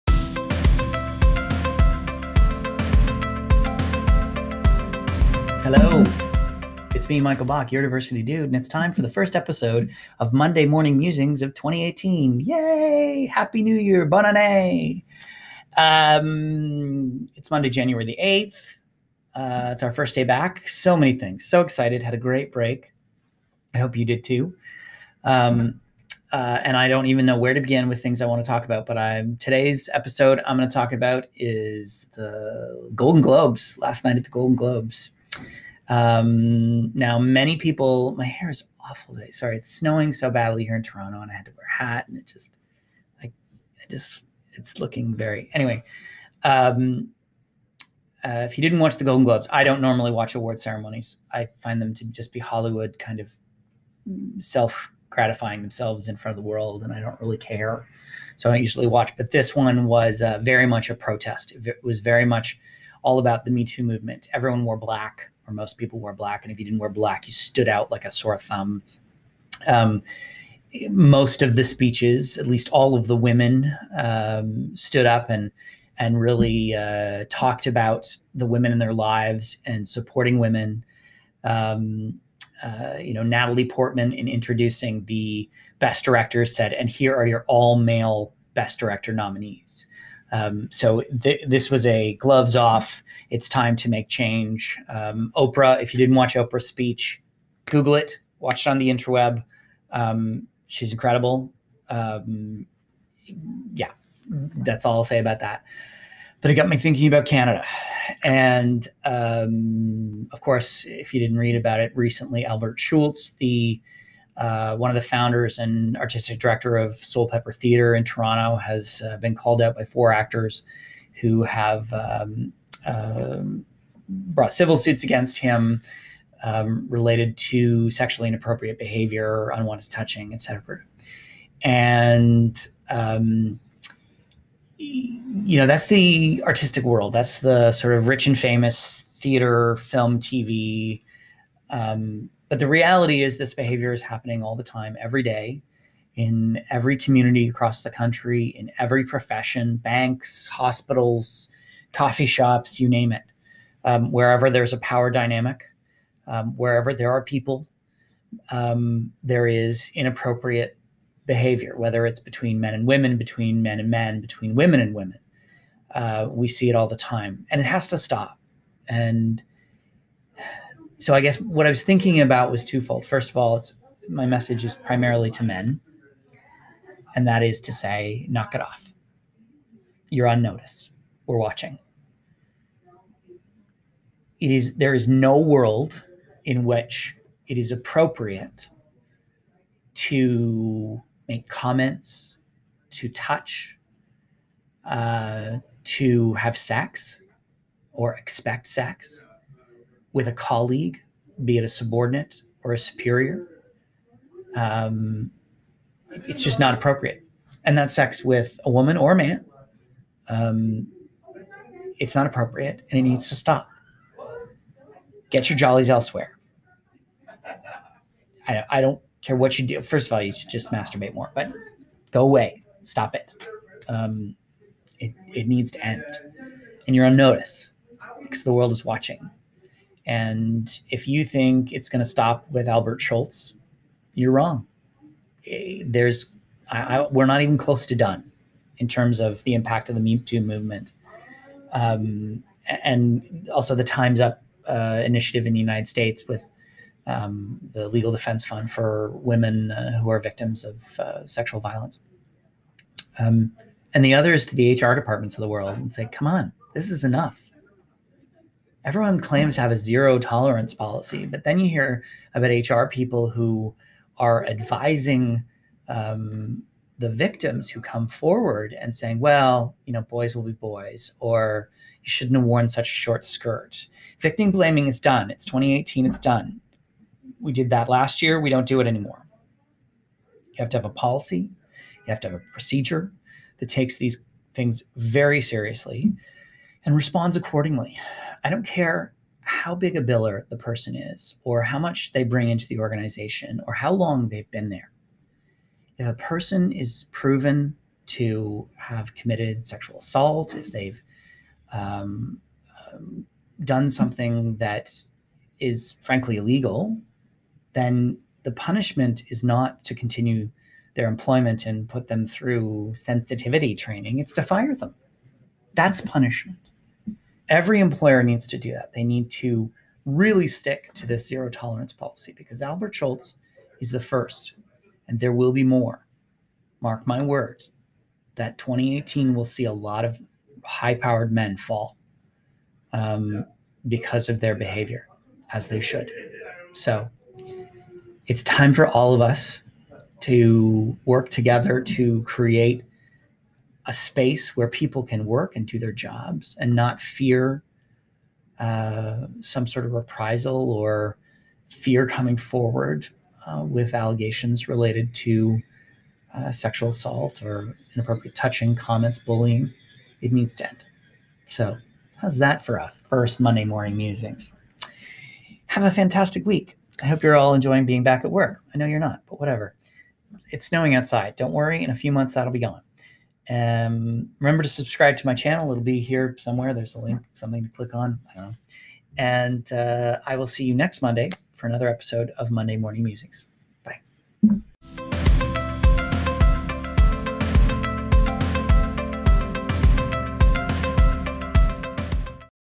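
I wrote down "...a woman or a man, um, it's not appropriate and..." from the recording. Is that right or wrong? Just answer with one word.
right.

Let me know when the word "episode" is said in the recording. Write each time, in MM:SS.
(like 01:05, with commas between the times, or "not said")
00:09, 00:29, 06:21.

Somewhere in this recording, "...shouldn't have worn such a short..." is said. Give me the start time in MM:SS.
04:32.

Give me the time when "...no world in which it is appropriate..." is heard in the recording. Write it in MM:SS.
03:05.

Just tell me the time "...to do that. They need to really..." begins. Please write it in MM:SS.
05:18.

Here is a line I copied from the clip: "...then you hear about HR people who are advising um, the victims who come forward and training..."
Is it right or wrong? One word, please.
wrong.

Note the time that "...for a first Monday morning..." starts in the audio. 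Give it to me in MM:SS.
06:02.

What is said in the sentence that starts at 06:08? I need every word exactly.
I know you're not, but whatever.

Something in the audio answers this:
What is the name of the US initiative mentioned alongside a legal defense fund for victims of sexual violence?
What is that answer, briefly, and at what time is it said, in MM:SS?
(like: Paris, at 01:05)
Times Up, at 04:03.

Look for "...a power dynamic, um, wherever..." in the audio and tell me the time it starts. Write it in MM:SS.
02:34.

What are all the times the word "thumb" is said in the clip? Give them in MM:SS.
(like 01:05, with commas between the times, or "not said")
01:08.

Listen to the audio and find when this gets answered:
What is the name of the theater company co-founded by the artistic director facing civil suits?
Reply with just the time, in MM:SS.
01:56.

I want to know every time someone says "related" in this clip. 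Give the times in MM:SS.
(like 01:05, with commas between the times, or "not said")
02:06, 05:54.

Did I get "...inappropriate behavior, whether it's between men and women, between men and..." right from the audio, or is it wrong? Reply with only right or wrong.
right.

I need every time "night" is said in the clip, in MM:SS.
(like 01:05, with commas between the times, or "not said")
00:34.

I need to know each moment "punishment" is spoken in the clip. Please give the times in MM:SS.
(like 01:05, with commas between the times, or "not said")
05:08, 05:16.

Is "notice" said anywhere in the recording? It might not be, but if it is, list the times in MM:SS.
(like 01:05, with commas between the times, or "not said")
03:00, 03:47.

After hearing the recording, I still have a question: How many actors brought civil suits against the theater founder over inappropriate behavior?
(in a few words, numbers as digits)
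4.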